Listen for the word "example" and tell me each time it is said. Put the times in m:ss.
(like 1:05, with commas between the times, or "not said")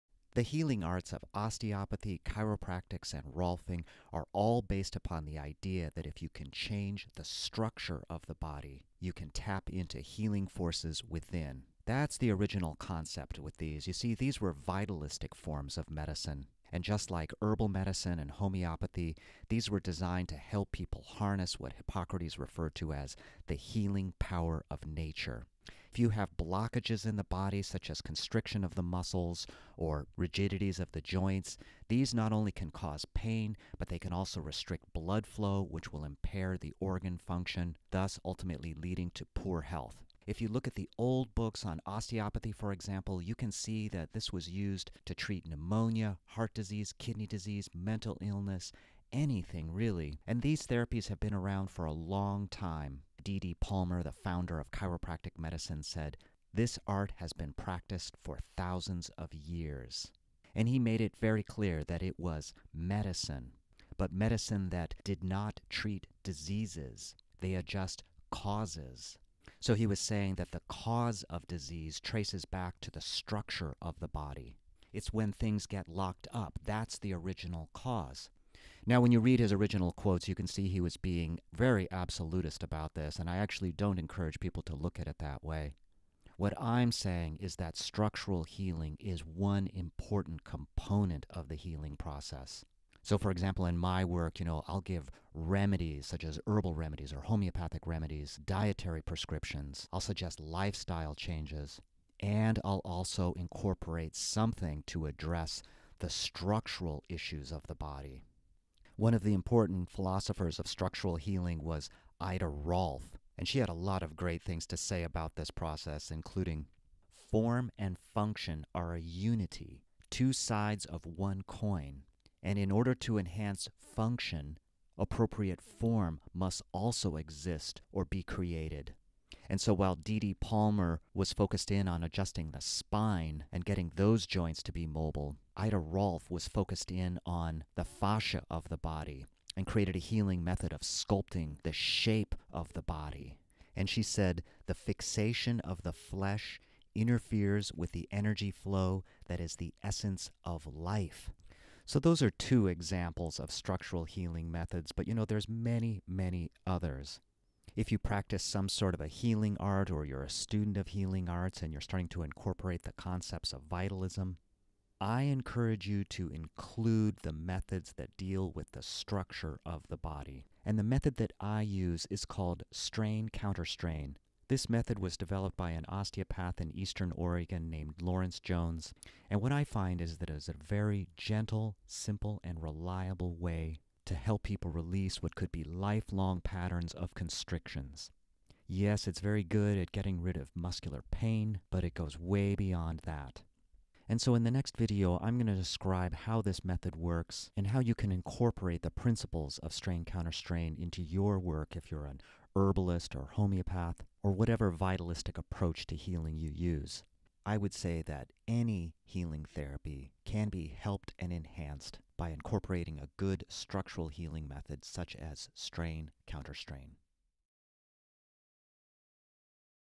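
0:42, 1:33, 2:32.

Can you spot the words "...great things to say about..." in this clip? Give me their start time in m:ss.
1:54.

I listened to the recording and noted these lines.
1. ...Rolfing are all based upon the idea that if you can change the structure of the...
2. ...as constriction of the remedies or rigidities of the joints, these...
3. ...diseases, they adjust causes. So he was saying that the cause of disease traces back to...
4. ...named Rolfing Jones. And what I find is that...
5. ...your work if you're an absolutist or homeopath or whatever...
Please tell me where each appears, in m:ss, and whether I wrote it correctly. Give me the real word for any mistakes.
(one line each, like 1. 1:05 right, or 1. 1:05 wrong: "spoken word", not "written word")
1. 0:03 right
2. 0:27 wrong: "muscles", not "remedies"
3. 1:06 right
4. 2:57 wrong: "Lawrence", not "Rolfing"
5. 3:21 wrong: "herbalist", not "absolutist".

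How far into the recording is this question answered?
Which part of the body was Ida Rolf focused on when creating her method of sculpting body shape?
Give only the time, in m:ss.
2:17.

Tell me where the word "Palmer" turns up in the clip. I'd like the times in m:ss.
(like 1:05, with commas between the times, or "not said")
0:53, 2:10.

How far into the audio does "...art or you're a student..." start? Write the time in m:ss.
2:39.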